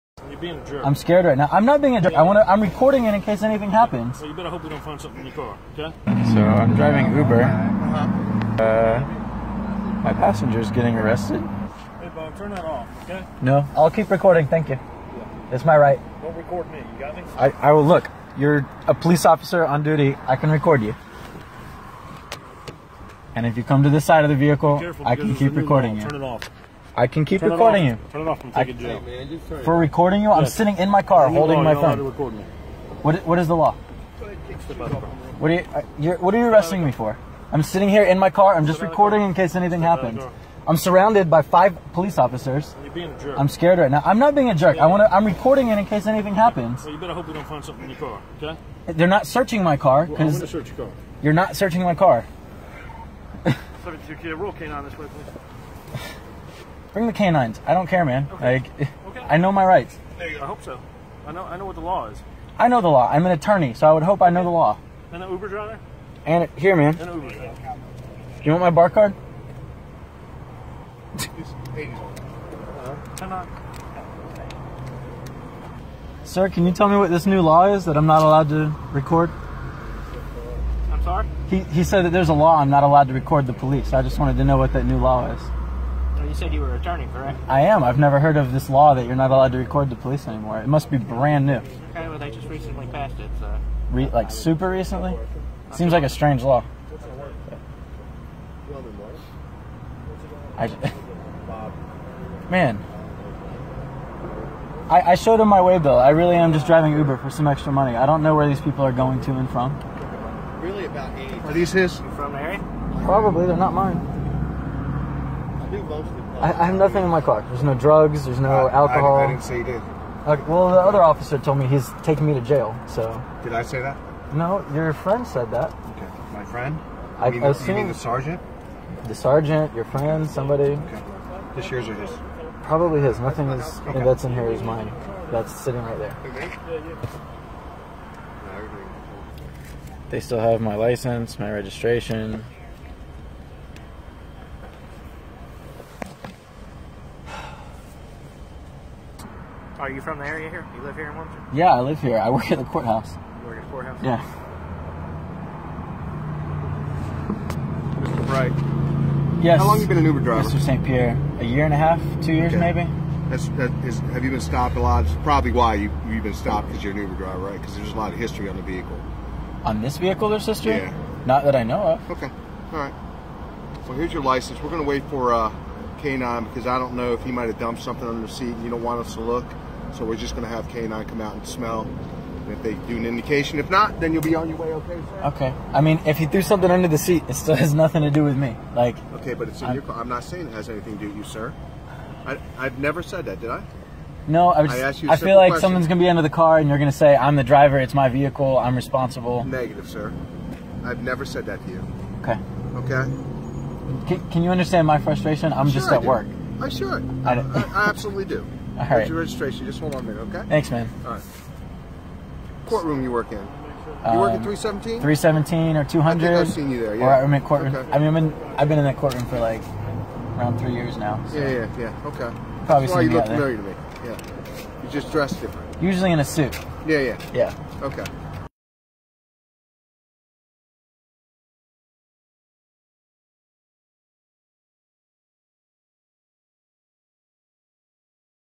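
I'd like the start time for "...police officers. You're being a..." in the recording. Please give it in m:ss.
0:41.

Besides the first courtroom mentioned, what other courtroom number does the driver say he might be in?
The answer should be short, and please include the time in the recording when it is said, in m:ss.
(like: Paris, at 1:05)
200, at 3:35.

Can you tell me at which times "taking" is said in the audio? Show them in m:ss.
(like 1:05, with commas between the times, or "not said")
0:28, 2:02.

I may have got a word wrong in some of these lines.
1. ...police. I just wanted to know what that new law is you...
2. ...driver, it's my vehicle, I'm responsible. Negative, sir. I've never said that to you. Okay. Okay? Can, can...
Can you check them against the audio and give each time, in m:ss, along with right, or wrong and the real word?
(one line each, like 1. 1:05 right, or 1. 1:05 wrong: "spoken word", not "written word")
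1. 1:23 right
2. 3:17 right.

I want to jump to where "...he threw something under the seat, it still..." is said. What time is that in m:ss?
3:06.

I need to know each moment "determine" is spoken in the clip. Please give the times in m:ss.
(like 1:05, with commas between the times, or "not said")
not said.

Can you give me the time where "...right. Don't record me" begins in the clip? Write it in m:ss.
0:15.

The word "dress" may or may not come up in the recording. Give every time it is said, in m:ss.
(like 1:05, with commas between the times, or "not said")
3:45.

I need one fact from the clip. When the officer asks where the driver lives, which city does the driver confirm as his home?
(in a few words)
Wilmington.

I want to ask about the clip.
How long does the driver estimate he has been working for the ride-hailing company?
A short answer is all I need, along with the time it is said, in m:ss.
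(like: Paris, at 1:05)
A year and a half, two years, at 2:41.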